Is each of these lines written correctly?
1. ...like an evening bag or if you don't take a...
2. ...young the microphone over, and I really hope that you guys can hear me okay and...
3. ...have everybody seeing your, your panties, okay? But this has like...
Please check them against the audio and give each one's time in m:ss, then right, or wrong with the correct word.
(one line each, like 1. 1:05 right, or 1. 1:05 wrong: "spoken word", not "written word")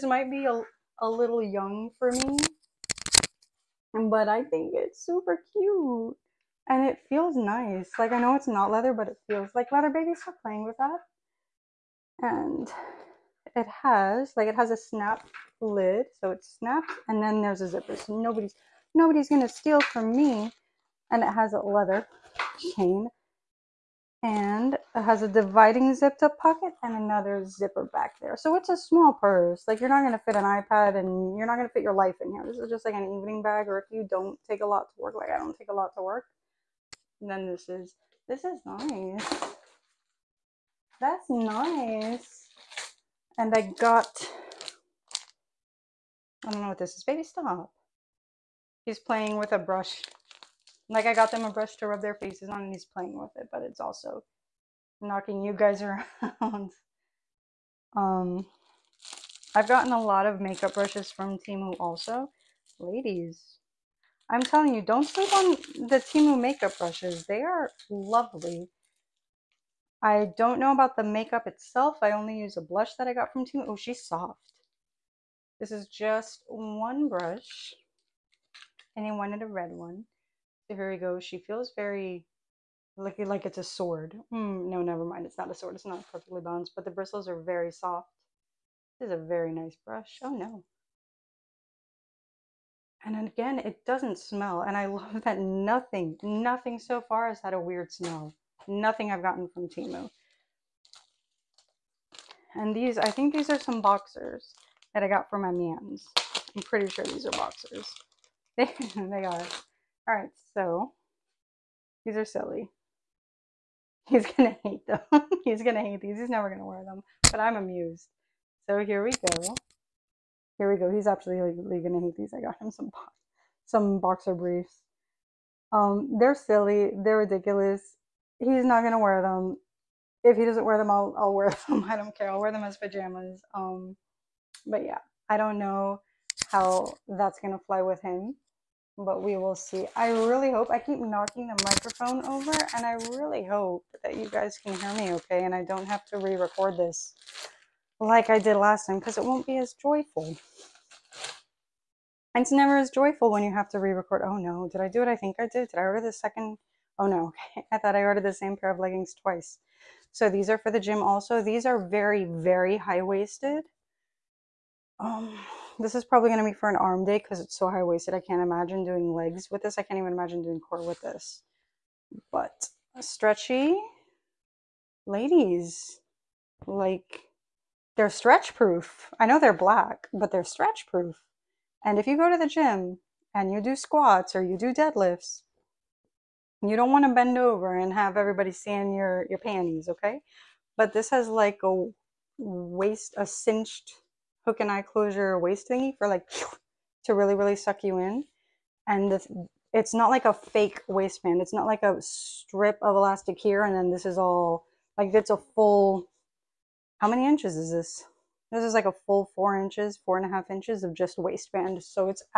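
1. 0:32 right
2. 2:20 wrong: "knocking", not "young"
3. 3:07 right.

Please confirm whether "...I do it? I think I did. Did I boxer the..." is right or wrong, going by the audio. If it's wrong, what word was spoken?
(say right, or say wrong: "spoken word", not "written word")
wrong: "order", not "boxer".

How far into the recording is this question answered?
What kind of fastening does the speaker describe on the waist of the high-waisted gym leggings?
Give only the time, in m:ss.
3:14.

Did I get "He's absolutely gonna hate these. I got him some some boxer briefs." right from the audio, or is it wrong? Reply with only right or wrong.
right.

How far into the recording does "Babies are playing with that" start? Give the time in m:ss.
0:09.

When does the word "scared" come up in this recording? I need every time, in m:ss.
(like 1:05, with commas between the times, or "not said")
not said.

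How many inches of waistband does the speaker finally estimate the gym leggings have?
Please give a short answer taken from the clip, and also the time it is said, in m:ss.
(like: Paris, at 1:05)
4 and a half inches, at 3:30.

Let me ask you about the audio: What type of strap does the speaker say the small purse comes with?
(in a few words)
Leather chain.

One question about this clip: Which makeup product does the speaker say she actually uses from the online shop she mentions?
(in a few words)
Blush.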